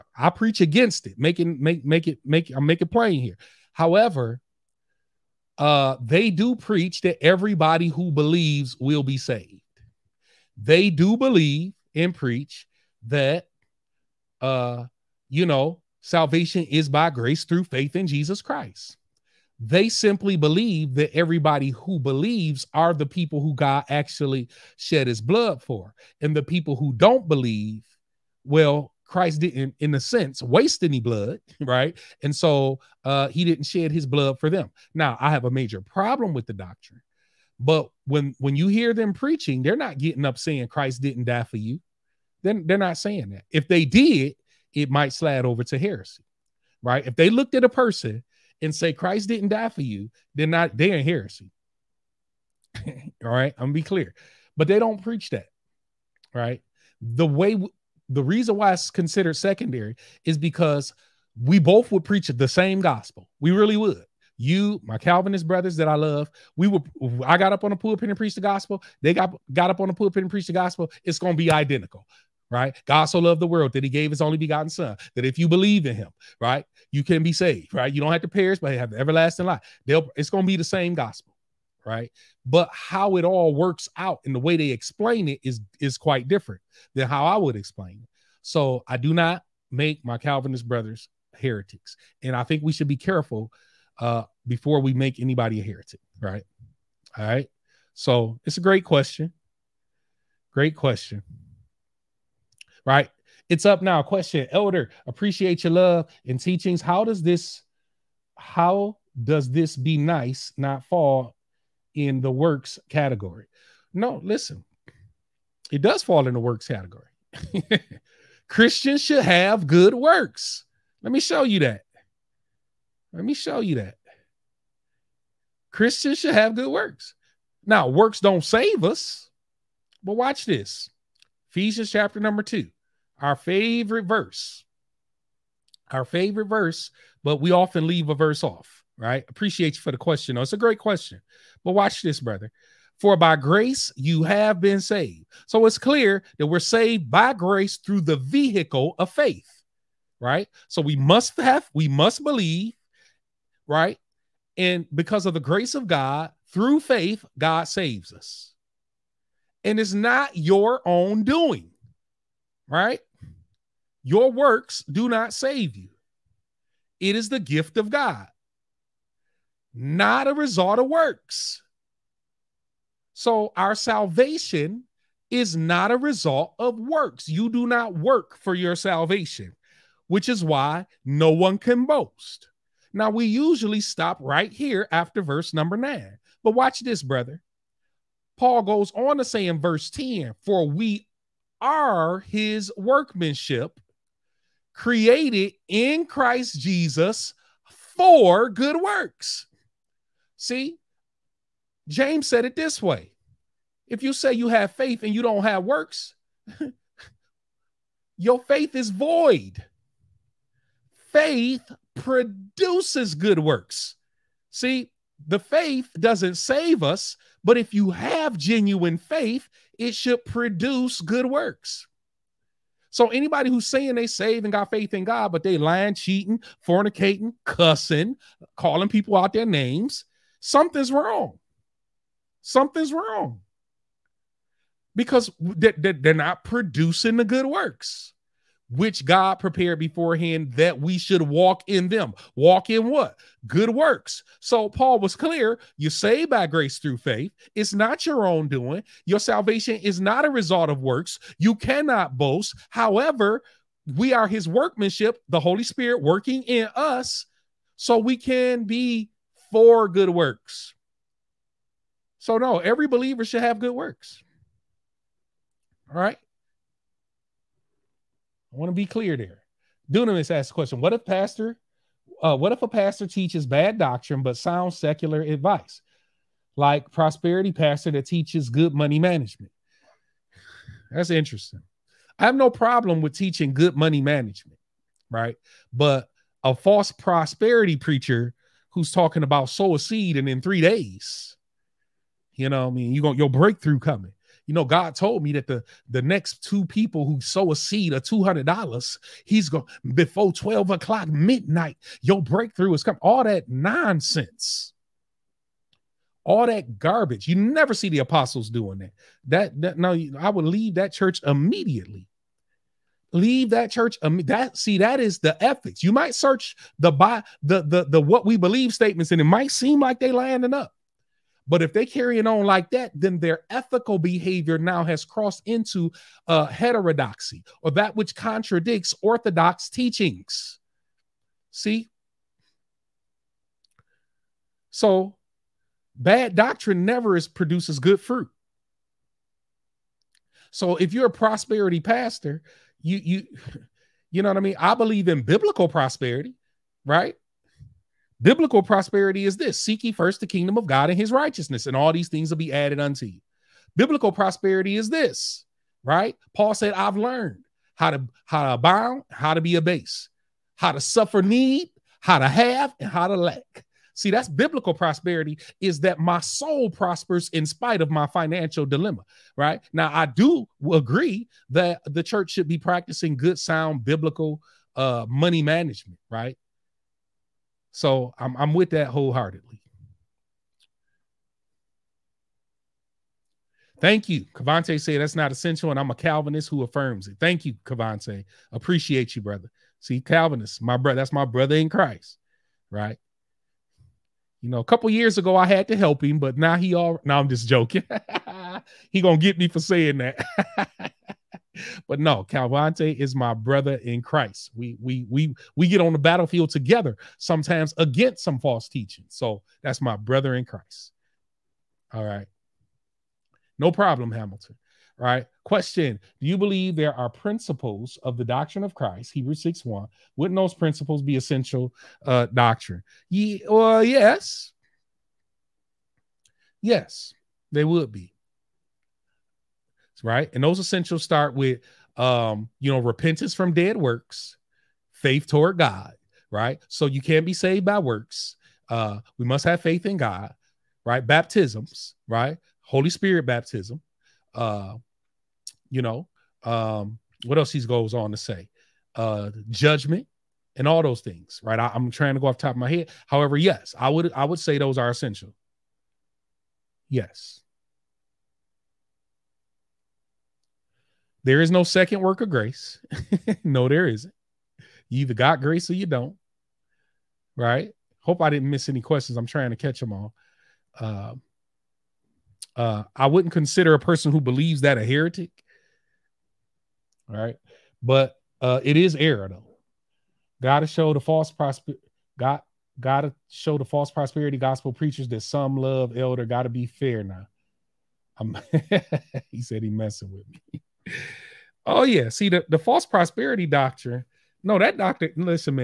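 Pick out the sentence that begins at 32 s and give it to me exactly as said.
And so uh, he didn't shed his blood for them.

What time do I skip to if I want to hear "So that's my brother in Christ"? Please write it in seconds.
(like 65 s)
409 s.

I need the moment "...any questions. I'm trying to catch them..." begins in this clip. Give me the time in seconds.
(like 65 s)
468 s.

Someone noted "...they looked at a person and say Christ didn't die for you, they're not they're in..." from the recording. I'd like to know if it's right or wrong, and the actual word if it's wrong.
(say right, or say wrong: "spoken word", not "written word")
right.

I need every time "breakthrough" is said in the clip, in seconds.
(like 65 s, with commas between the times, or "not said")
293 s, 302 s.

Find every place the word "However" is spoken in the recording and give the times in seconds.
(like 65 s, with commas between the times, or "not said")
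3 s, 252 s, 453 s.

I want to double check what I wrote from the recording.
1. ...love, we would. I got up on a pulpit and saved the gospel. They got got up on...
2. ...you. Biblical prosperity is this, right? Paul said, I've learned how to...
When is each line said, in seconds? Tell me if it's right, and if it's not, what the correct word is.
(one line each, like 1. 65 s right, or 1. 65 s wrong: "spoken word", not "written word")
1. 65 s wrong: "preached", not "saved"
2. 353 s right.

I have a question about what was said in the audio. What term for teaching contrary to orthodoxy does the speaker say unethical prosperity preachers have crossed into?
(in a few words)
Heterodoxy.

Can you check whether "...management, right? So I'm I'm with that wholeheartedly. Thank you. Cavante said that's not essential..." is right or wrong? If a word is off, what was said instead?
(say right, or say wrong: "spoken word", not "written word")
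right.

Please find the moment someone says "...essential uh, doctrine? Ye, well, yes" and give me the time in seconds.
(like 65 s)
421 s.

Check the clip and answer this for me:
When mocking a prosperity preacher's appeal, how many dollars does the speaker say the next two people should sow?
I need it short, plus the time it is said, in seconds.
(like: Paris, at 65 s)
$200, at 298 s.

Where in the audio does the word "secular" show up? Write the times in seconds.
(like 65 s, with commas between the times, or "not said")
274 s.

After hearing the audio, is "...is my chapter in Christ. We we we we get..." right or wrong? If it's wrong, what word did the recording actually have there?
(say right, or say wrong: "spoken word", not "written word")
wrong: "brother", not "chapter".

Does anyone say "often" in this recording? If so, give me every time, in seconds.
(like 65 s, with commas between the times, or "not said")
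137 s.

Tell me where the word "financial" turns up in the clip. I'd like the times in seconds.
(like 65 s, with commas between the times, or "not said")
368 s.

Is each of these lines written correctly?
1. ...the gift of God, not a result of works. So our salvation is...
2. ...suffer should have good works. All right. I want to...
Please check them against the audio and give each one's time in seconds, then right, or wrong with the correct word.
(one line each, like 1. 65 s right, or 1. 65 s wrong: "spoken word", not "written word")
1. 167 s right
2. 262 s wrong: "believer", not "suffer".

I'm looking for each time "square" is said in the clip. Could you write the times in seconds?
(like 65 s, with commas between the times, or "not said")
not said.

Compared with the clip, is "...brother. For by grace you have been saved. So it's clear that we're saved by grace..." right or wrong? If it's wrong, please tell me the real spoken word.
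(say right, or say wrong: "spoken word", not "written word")
right.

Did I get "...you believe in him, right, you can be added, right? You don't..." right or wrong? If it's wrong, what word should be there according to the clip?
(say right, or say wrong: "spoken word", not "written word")
wrong: "saved", not "added".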